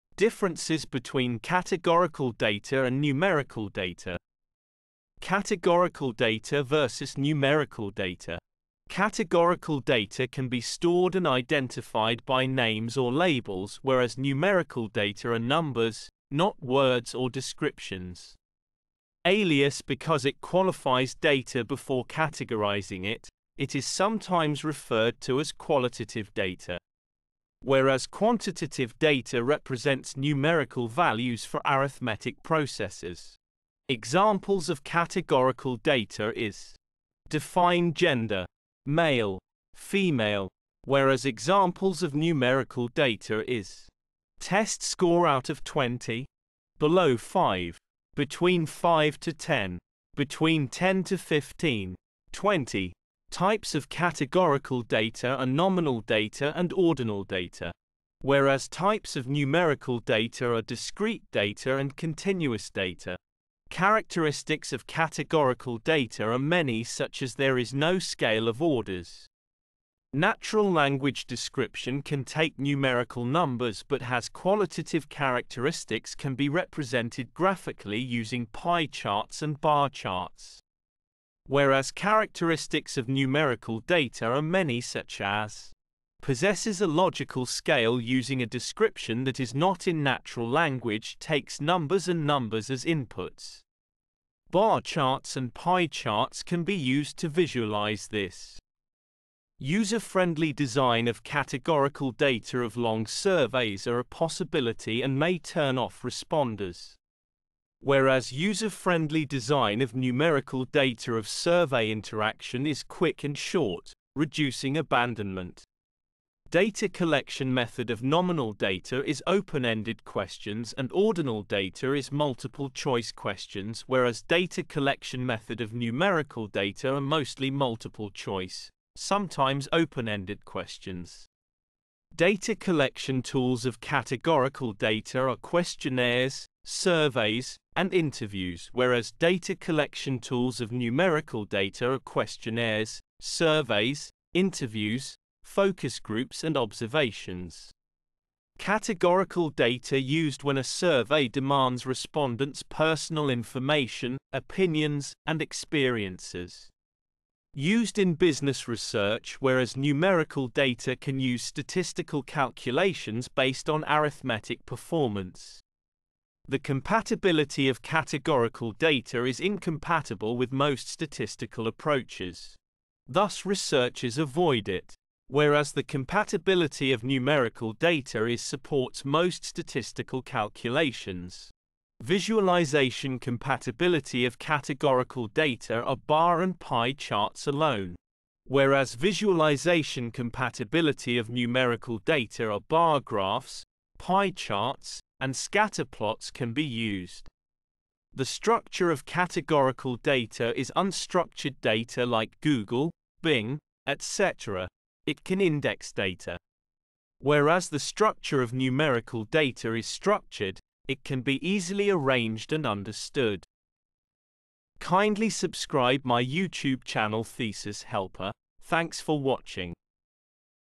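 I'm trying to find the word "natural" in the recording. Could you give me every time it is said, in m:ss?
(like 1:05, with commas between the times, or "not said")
1:10, 1:30.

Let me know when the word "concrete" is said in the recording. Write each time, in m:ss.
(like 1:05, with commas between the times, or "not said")
not said.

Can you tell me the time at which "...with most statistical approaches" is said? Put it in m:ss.
2:50.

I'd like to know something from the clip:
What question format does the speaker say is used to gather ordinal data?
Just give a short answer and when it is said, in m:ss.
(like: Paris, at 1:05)
Multiple-choice questions, at 2:02.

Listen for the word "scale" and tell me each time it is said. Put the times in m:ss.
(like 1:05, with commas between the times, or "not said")
1:07, 1:27.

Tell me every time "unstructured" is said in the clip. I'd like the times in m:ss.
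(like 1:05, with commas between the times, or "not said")
3:20.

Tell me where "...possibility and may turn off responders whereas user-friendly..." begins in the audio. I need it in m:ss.
1:44.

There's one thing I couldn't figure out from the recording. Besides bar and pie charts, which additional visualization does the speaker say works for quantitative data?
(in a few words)
Scatter plots.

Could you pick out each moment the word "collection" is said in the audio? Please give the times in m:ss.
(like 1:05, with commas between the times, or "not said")
1:56, 2:04, 2:12, 2:19.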